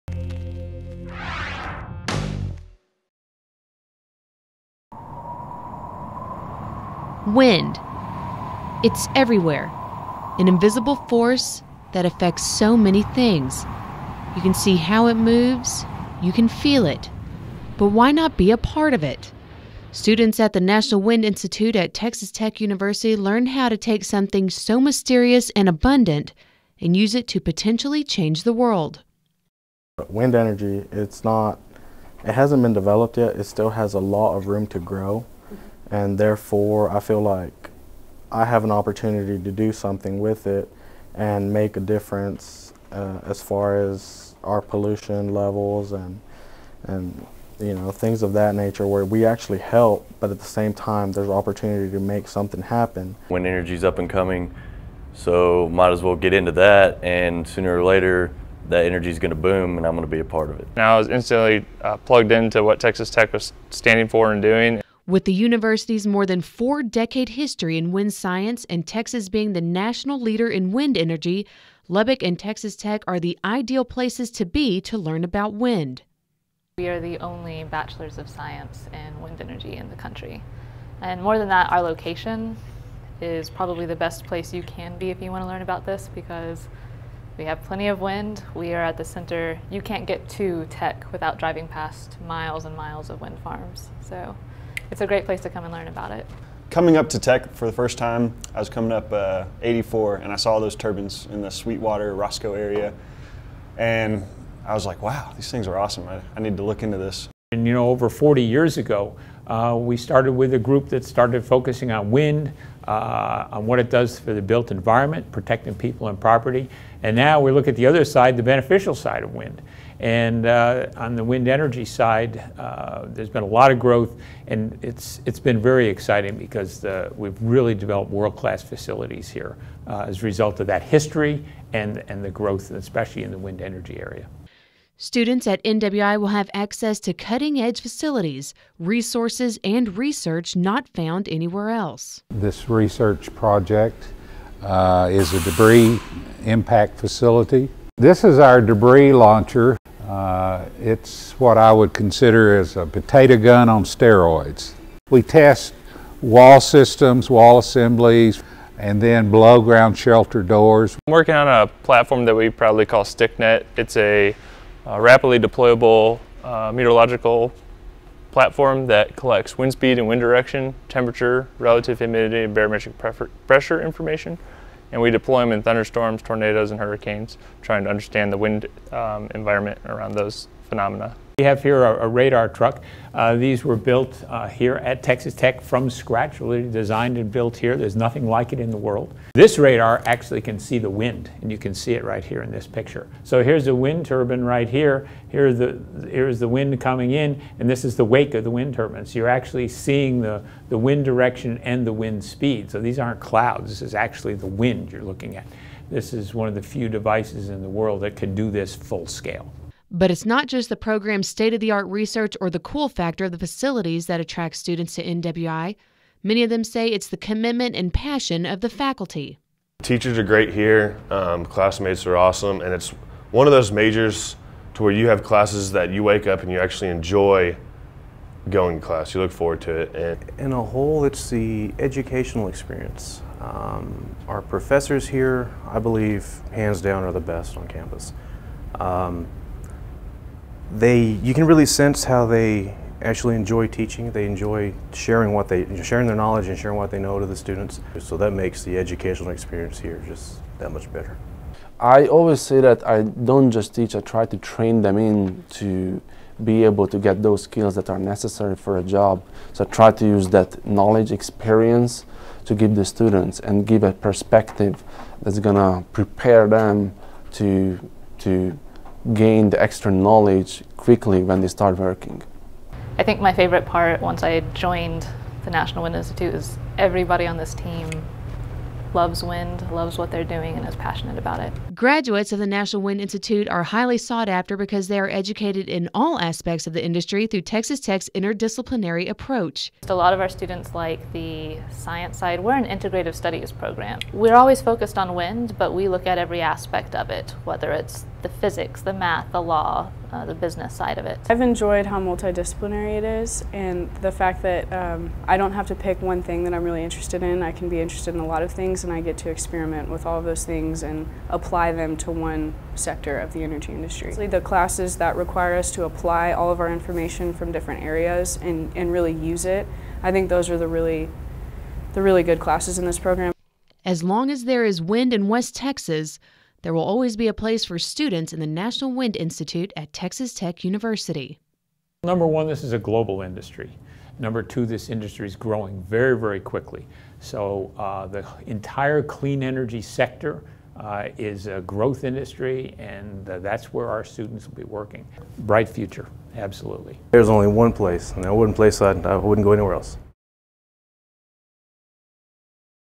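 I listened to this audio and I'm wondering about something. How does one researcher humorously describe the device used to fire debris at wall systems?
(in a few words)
A potato gun on steroids.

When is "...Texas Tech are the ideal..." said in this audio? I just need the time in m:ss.
1:12.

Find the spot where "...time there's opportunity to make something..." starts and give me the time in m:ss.
0:50.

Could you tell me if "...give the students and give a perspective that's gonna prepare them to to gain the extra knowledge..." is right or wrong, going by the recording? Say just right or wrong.
right.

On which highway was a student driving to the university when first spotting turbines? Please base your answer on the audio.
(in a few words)
84.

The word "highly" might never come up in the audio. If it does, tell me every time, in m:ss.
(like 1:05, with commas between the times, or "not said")
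4:43.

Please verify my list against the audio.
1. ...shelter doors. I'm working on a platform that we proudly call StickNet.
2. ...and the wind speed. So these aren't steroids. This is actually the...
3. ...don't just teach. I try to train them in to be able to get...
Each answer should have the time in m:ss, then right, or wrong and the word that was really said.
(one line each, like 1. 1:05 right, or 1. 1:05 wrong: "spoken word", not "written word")
1. 2:39 right
2. 3:21 wrong: "clouds", not "steroids"
3. 4:13 right.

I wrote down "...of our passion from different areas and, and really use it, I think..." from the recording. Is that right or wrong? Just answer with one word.
wrong.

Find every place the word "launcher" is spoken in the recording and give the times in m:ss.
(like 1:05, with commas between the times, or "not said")
2:29.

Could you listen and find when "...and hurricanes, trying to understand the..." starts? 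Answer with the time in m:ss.
2:56.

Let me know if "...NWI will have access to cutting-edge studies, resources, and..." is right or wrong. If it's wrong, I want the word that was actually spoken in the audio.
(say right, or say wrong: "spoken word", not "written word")
wrong: "facilities", not "studies".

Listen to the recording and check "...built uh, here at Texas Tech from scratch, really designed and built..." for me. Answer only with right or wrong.
right.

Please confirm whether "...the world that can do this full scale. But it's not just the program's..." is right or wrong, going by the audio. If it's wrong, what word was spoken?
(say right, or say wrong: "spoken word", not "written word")
right.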